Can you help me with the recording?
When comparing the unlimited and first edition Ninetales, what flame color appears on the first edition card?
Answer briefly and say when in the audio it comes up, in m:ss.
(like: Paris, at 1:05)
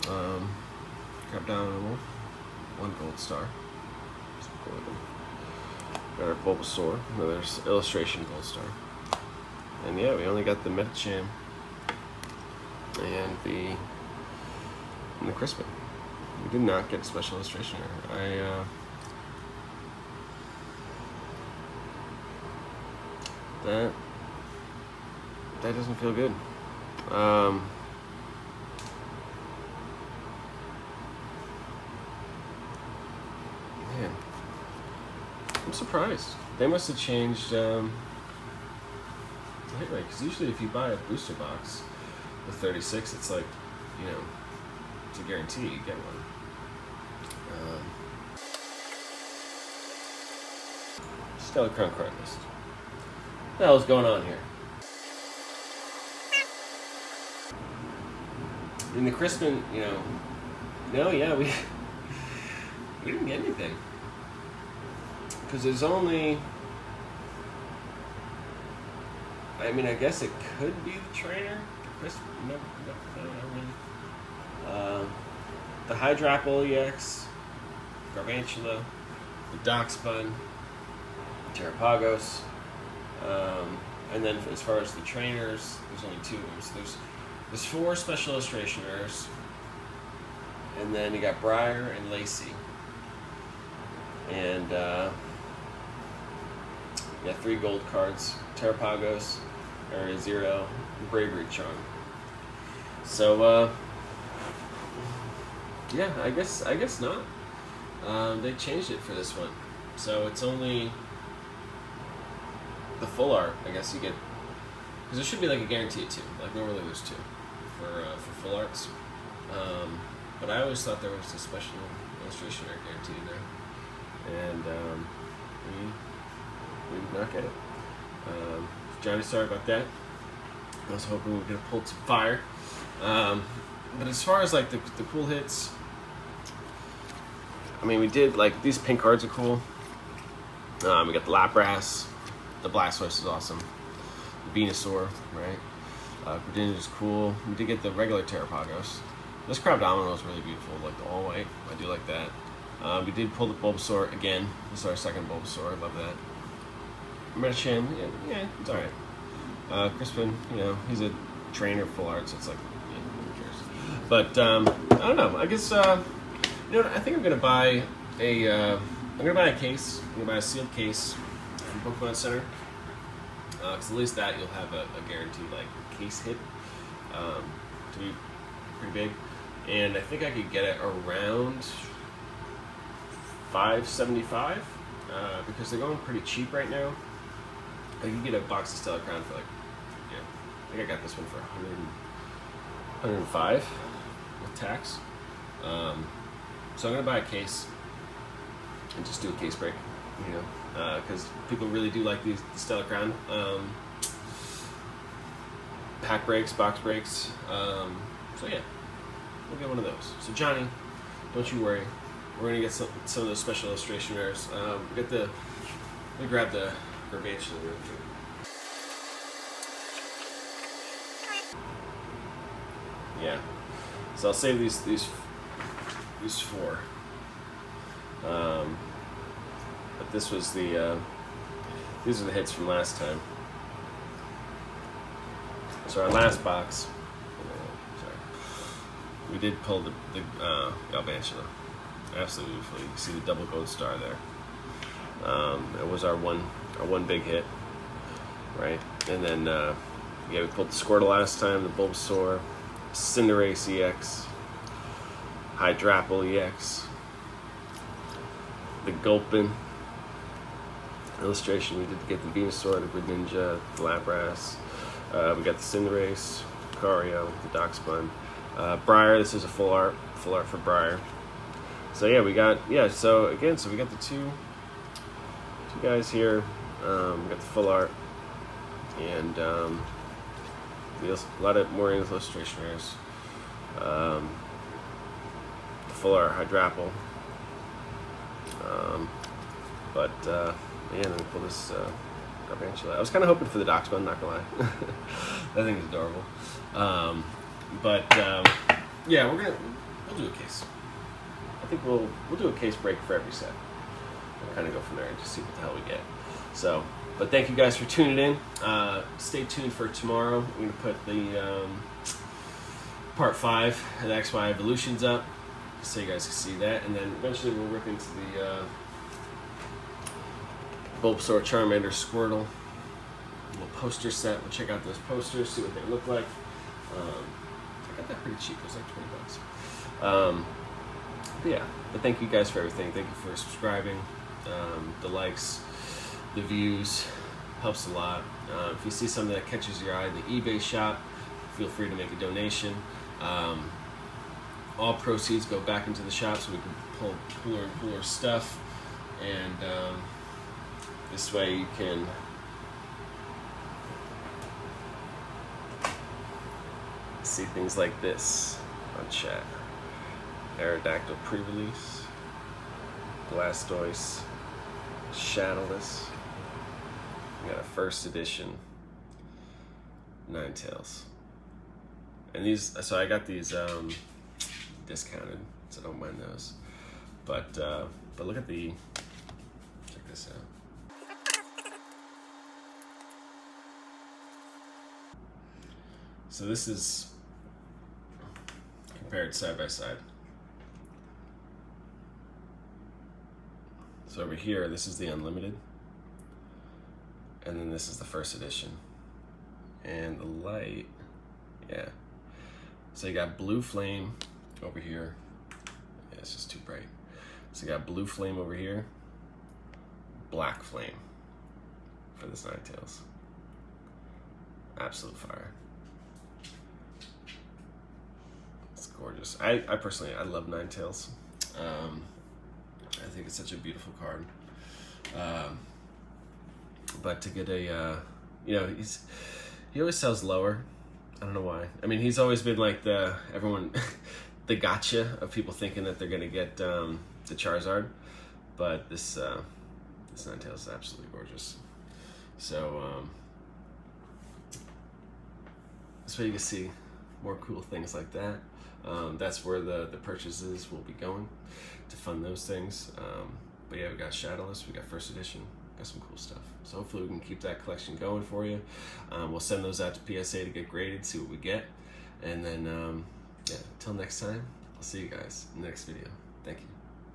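Black, at 6:50.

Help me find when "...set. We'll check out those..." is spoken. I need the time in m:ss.
5:24.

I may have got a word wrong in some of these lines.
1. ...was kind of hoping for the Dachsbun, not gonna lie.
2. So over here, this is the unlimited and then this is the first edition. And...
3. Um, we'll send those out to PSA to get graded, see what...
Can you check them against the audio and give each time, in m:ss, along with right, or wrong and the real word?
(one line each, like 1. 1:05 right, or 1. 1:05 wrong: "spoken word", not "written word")
1. 4:52 right
2. 6:34 right
3. 7:39 right.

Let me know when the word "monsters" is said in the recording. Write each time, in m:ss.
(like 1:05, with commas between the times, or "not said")
not said.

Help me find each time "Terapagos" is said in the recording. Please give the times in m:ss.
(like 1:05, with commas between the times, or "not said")
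1:21, 1:38, 2:28.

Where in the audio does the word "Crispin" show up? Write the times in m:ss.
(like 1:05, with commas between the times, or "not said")
0:15, 0:59, 2:39.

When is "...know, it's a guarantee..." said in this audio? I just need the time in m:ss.
0:44.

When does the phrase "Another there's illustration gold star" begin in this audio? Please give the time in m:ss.
0:07.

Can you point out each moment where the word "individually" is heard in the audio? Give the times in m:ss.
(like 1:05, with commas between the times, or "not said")
not said.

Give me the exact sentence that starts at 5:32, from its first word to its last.
Thank you for subscribing, um, the likes the views helps a lot.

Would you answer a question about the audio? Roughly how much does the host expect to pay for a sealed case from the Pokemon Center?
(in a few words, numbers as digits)
$575.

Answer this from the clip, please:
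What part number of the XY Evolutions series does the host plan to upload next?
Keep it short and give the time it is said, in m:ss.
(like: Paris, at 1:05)
Part 5, at 5:13.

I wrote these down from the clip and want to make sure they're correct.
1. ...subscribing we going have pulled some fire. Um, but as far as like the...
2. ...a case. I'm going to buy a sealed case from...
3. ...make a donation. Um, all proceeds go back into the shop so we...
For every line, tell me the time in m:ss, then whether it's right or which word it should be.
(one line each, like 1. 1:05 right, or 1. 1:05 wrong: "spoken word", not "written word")
1. 2:11 wrong: "hoping", not "subscribing"
2. 2:49 right
3. 5:41 right.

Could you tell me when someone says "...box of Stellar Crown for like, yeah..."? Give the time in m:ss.
3:08.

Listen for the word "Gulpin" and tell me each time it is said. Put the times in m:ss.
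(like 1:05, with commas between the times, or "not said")
4:18.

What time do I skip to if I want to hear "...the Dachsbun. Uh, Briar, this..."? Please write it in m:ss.
4:27.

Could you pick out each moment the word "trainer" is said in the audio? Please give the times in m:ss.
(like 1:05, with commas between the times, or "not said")
1:11, 1:25, 2:41.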